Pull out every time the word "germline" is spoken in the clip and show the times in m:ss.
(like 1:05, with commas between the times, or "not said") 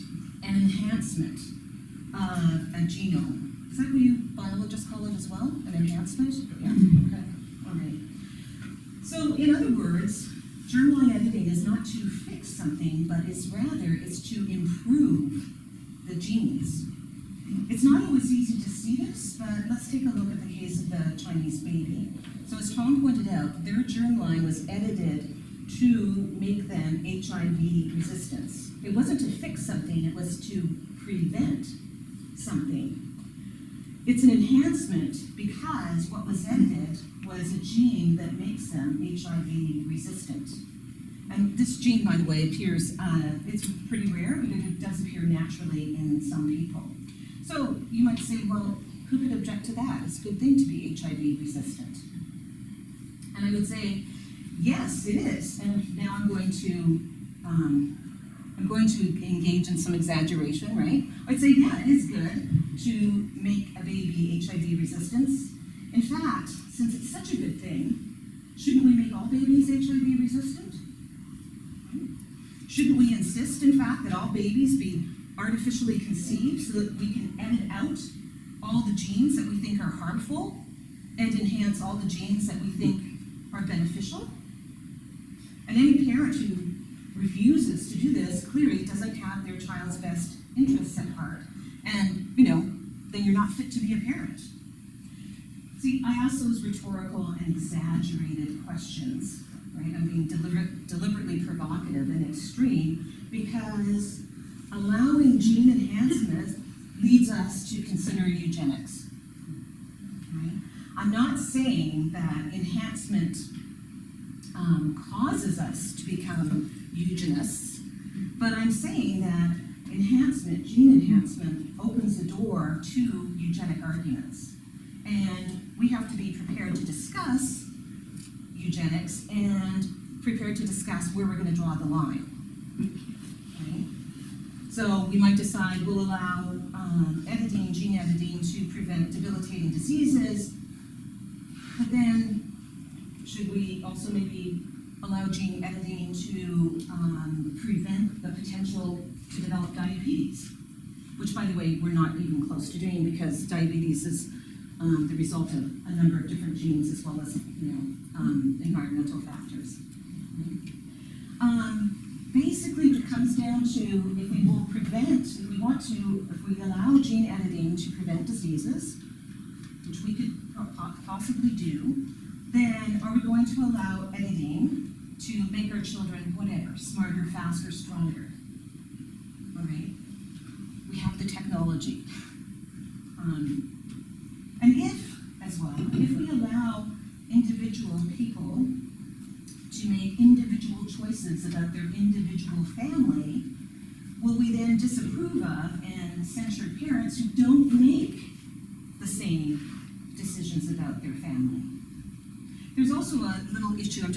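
0:10, 0:23.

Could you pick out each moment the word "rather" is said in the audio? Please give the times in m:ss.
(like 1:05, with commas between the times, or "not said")
0:13.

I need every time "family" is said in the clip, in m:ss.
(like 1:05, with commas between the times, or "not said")
3:12, 3:21.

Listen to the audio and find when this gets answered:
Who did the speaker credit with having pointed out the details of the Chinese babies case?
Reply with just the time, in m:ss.
0:22.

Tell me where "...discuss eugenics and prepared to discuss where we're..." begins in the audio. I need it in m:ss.
2:06.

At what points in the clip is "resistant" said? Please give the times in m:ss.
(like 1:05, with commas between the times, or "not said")
0:27, 0:39, 0:51, 1:04, 1:10.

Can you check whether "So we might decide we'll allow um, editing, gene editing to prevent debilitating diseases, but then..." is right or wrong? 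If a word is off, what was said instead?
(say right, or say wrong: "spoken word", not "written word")
right.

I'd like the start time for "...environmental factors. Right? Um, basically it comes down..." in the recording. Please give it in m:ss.
2:38.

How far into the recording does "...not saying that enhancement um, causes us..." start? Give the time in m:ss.
1:51.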